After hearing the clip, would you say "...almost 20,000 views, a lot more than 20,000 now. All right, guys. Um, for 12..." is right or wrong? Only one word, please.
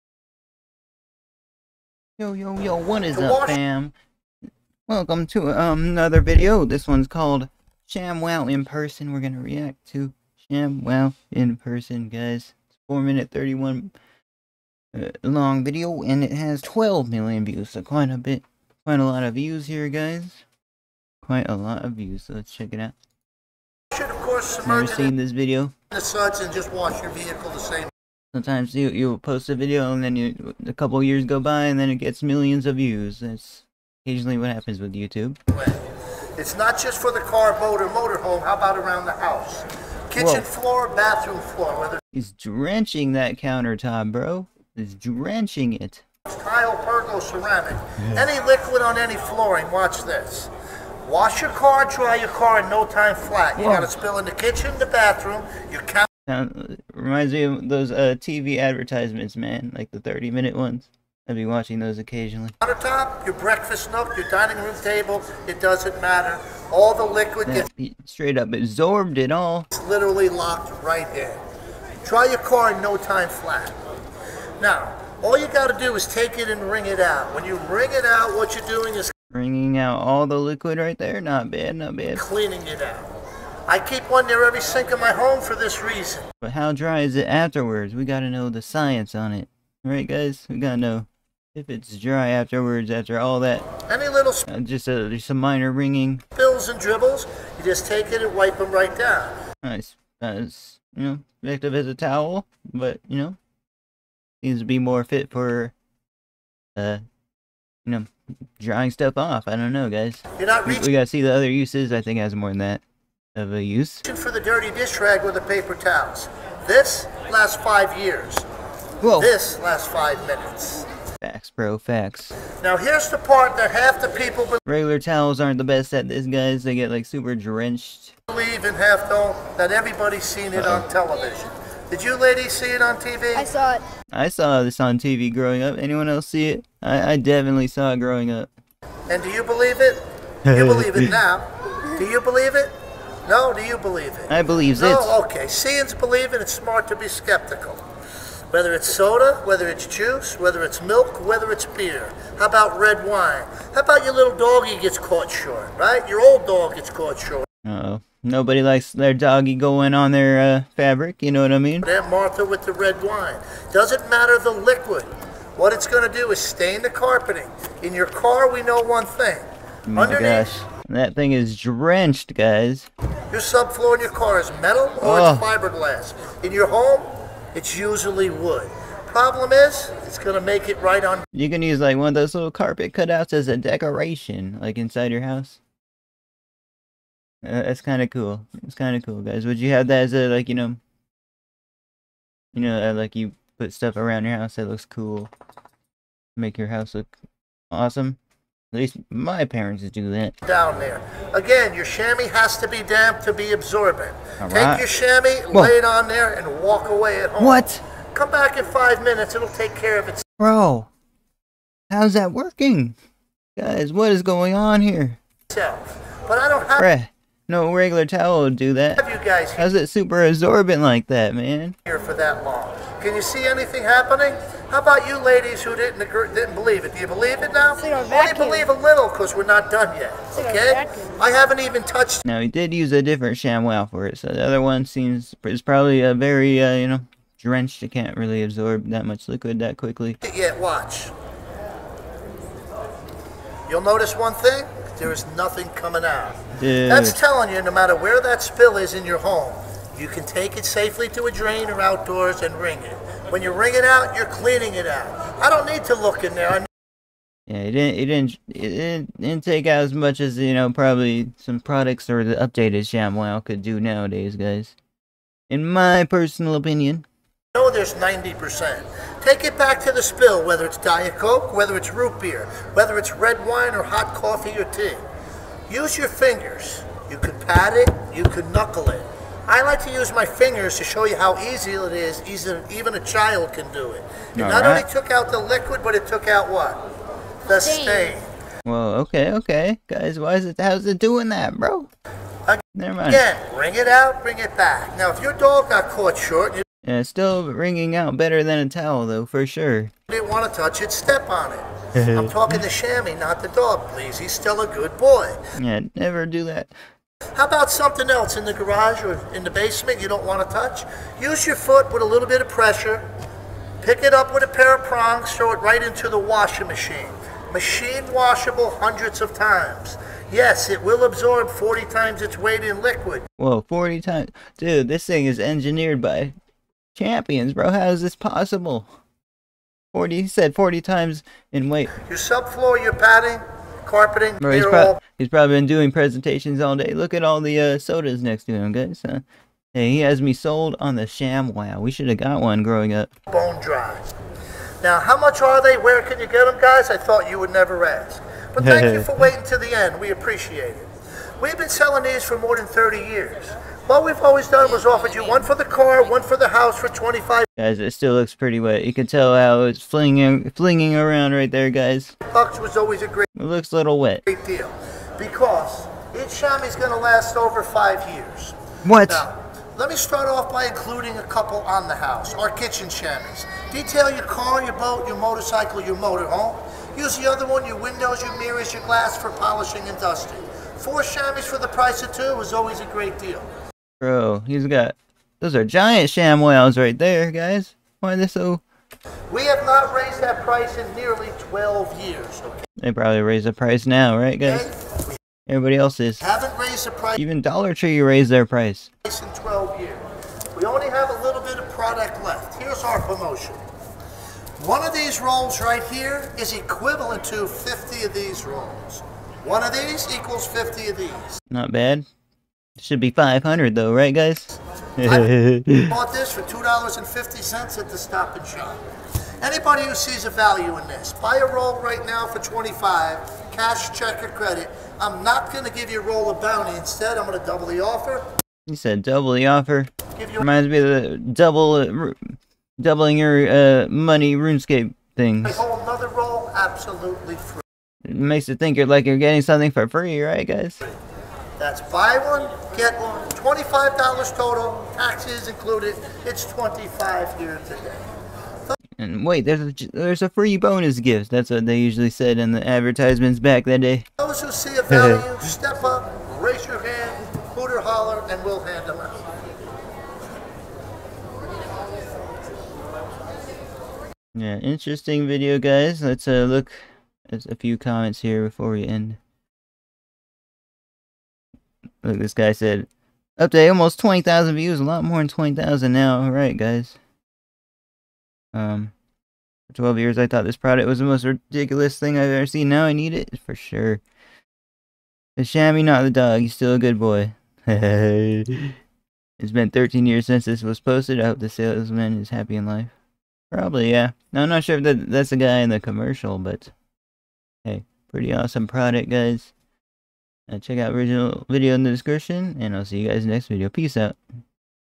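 right.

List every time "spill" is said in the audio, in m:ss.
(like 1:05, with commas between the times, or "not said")
0:53, 1:36, 4:08, 4:30.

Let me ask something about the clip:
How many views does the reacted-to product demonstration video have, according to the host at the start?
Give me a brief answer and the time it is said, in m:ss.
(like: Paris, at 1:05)
12 million, at 0:16.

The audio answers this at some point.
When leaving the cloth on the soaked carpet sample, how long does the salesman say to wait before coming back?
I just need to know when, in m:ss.
3:28.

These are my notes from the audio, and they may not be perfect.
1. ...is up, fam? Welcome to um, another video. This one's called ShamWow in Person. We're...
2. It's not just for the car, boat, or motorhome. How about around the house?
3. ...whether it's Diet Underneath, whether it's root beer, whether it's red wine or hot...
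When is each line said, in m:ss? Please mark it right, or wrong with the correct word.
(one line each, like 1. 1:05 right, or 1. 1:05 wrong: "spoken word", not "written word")
1. 0:03 right
2. 0:36 right
3. 4:30 wrong: "Coke", not "Underneath".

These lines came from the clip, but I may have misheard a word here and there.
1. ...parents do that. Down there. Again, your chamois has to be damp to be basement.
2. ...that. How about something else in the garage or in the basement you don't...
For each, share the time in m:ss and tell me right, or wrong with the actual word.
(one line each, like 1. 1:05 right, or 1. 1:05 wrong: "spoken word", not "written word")
1. 3:19 wrong: "absorbent", not "basement"
2. 5:06 right.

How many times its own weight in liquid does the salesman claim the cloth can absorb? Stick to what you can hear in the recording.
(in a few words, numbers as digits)
40 times.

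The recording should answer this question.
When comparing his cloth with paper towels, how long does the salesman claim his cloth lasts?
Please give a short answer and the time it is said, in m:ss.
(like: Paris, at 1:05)
5 years, at 1:56.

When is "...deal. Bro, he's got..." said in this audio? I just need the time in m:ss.
6:23.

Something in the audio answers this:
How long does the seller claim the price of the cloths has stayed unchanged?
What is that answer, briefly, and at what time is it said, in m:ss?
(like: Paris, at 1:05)
Nearly 12 years, at 6:30.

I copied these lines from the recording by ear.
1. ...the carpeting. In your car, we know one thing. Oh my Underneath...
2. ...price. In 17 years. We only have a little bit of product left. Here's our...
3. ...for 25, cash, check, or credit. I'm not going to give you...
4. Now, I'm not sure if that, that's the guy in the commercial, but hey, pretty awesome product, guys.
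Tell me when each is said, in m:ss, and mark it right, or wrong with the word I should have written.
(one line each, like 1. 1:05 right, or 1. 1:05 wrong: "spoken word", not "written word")
1. 2:46 right
2. 6:38 wrong: "12", not "17"
3. 7:02 right
4. 8:14 right.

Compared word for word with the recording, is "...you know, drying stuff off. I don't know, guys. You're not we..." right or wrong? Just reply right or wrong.
right.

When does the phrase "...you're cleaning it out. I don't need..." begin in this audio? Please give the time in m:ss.
4:14.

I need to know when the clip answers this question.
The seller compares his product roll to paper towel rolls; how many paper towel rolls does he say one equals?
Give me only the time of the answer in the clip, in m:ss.
6:47.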